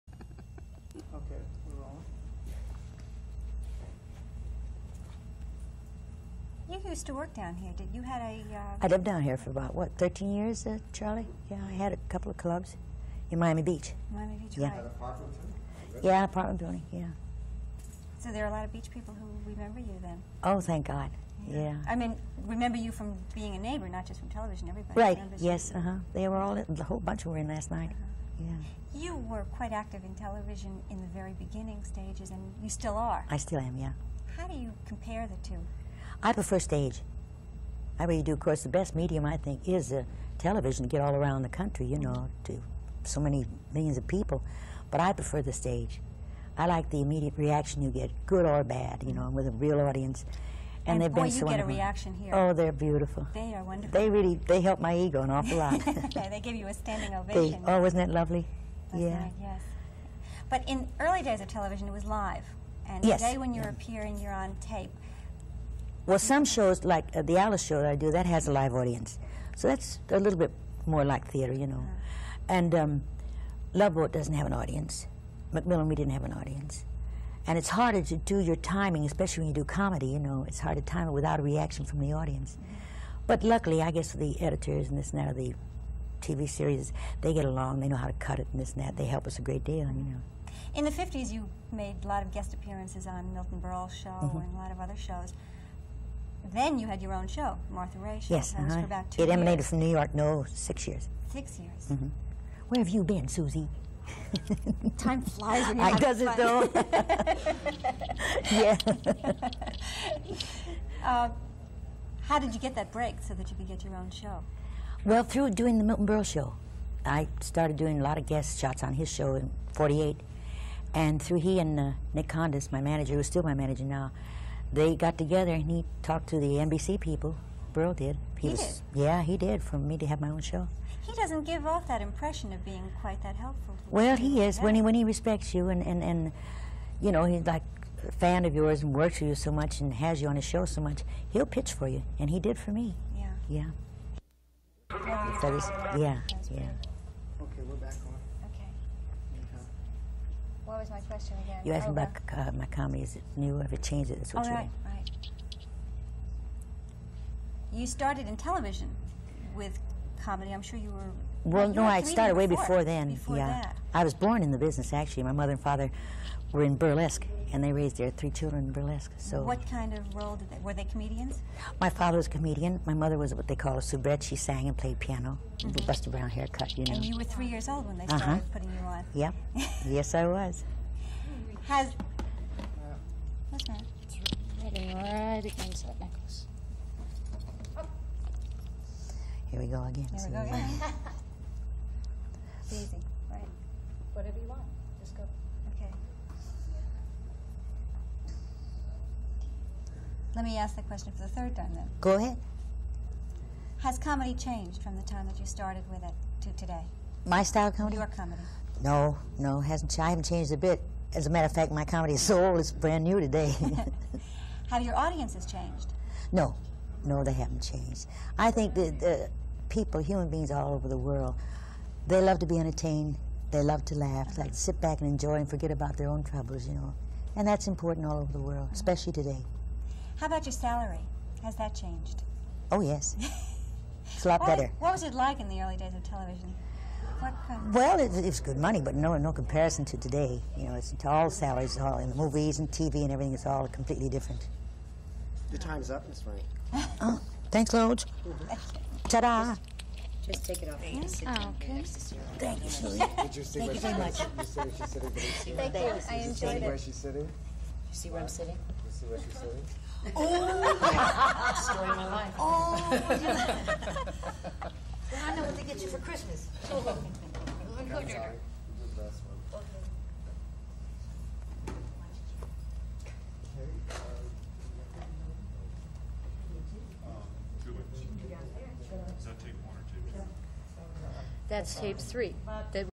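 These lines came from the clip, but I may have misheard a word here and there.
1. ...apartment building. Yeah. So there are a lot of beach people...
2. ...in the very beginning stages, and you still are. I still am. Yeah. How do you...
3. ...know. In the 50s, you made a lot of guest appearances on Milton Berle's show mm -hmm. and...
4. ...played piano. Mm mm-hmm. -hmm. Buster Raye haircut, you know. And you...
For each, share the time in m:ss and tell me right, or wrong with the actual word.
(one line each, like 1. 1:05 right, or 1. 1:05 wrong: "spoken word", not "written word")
1. 0:16 right
2. 0:30 right
3. 1:30 right
4. 2:54 wrong: "Brown", not "Raye".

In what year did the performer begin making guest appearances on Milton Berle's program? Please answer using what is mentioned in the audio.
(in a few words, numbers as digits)
1948.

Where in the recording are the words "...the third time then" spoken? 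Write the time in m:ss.
3:21.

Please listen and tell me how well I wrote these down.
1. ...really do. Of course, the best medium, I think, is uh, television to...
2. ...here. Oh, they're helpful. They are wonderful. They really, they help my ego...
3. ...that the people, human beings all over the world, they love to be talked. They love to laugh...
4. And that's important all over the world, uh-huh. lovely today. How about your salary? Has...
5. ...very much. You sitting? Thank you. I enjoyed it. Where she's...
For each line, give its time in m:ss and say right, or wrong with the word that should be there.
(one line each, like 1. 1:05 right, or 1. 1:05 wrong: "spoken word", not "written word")
1. 0:38 right
2. 0:52 wrong: "beautiful", not "helpful"
3. 3:38 wrong: "entertained", not "talked"
4. 3:47 wrong: "especially", not "lovely"
5. 4:13 right.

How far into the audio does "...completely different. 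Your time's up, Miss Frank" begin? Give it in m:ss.
4:03.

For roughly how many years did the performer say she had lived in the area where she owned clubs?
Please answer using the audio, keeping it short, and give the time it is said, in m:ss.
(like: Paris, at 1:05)
13, at 0:09.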